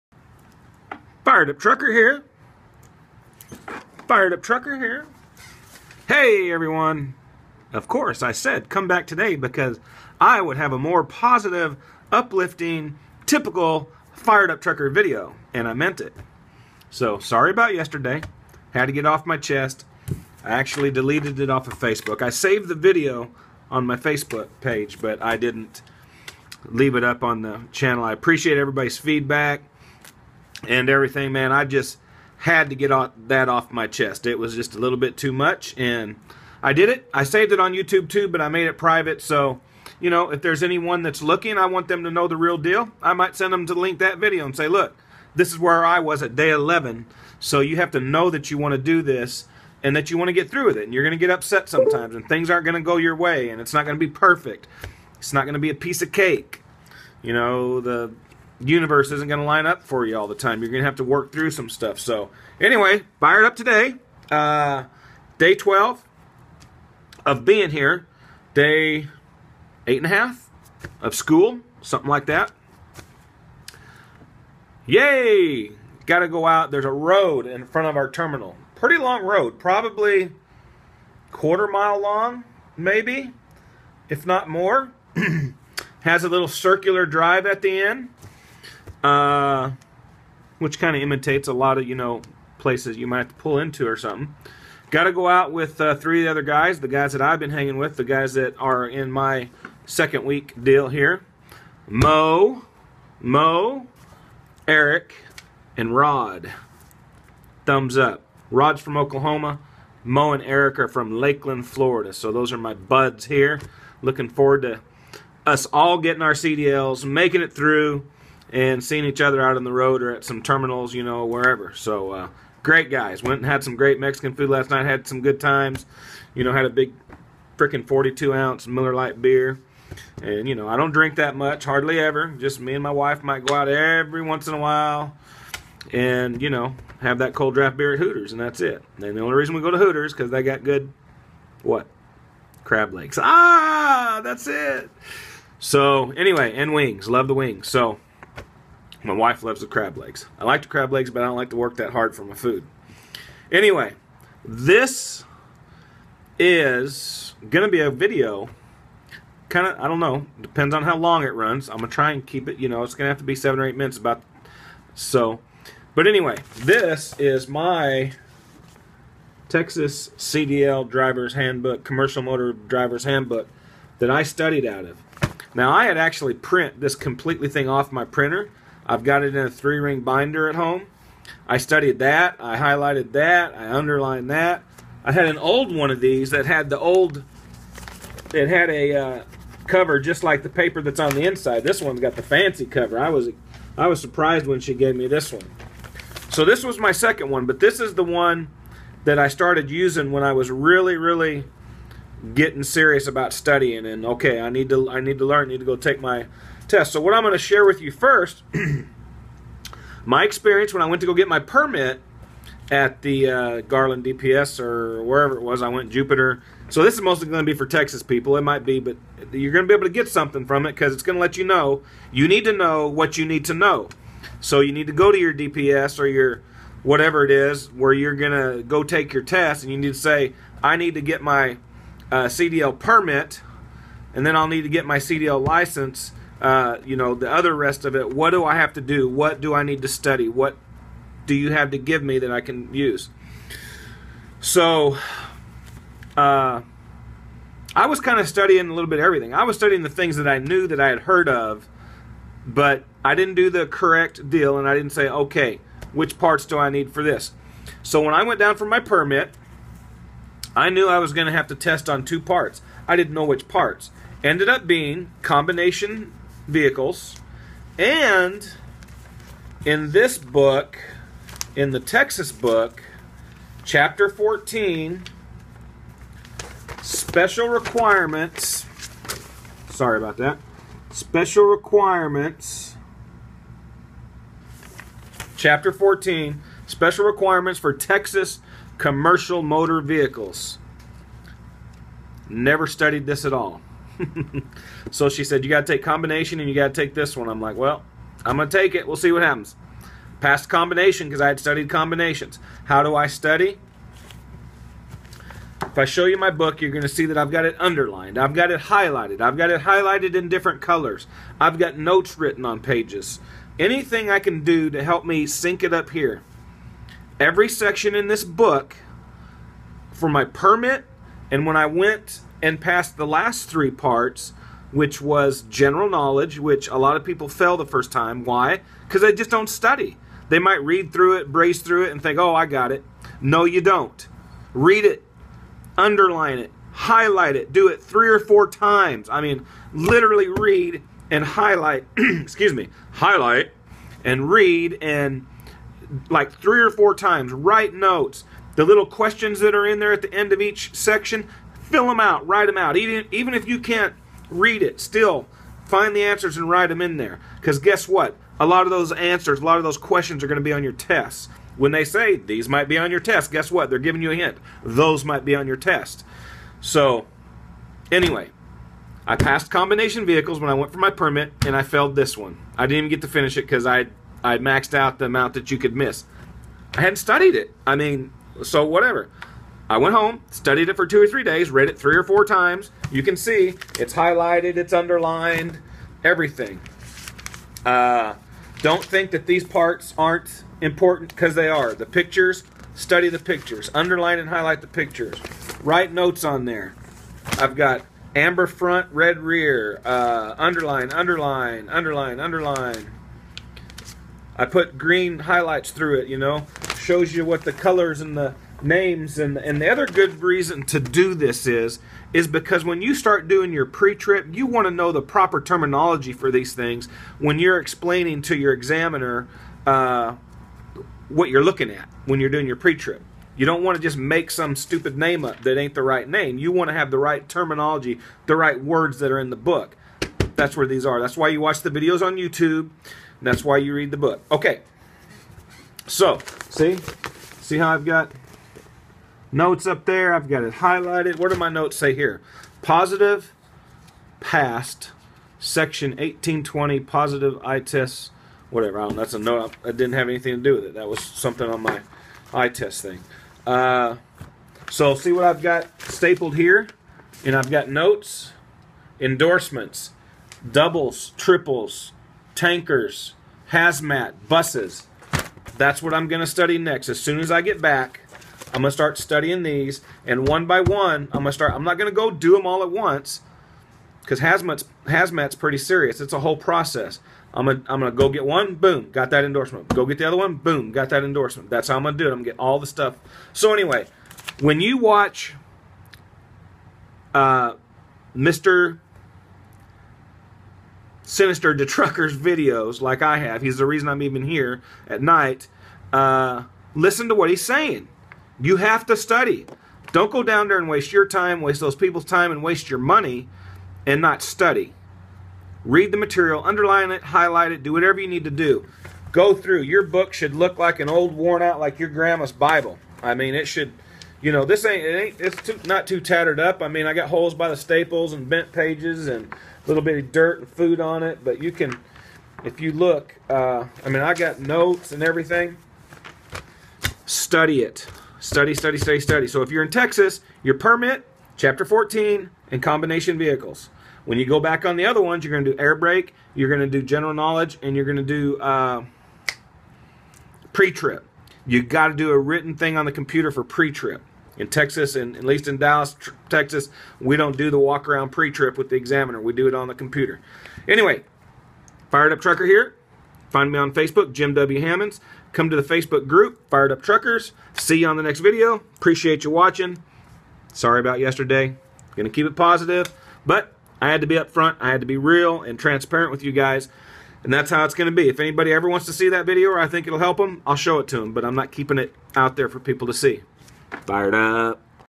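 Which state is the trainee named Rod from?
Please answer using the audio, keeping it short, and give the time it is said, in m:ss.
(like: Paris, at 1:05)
Oklahoma, at 1:48.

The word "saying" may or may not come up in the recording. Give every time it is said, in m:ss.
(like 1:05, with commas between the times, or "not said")
8:17.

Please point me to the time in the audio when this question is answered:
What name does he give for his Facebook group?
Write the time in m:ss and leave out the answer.
9:16.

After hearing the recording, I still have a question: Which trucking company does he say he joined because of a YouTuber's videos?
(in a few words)
Knight.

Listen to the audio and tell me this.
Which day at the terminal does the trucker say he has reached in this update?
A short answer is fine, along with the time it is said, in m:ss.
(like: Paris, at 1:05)
12, at 1:05.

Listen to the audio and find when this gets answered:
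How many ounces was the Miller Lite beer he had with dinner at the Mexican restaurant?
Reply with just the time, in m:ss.
2:07.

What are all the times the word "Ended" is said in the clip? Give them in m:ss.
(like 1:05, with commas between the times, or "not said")
4:24.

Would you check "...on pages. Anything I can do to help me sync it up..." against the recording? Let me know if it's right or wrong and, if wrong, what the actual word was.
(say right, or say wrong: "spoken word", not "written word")
right.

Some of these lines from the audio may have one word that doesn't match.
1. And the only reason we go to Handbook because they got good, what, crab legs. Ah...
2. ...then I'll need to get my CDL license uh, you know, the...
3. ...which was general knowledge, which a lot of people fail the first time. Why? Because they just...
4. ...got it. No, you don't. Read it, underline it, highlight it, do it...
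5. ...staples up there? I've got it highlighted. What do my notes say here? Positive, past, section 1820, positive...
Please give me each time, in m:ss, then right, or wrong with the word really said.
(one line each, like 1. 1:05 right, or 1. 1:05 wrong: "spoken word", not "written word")
1. 2:18 wrong: "Hooters", not "Handbook"
2. 3:54 right
3. 5:24 right
4. 5:32 right
5. 7:19 wrong: "notes", not "staples".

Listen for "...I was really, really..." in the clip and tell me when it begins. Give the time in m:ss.
3:20.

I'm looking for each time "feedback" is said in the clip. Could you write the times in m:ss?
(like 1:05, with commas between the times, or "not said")
0:28.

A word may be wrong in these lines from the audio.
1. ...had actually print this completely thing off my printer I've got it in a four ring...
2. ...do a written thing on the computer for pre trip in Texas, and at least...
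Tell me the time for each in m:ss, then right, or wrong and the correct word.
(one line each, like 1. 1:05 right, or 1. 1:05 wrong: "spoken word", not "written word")
1. 2:55 wrong: "three", not "four"
2. 9:01 right.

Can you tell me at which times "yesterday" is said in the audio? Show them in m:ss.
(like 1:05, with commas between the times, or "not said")
0:17, 9:20.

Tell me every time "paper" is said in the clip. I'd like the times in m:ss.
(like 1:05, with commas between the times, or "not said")
3:10.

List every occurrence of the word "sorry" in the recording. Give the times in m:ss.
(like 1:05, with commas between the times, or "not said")
0:17, 4:39, 9:20.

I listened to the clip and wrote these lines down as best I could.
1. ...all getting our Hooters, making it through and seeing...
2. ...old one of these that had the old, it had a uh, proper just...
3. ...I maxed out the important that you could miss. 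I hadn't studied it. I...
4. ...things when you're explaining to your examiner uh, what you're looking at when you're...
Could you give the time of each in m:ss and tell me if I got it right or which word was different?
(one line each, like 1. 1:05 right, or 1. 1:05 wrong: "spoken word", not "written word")
1. 1:55 wrong: "CDLs", not "Hooters"
2. 3:05 wrong: "cover", not "proper"
3. 6:14 wrong: "amount", not "important"
4. 6:56 right.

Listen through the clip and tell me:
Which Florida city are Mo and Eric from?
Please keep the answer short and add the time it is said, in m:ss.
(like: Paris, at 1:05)
Lakeland, at 1:51.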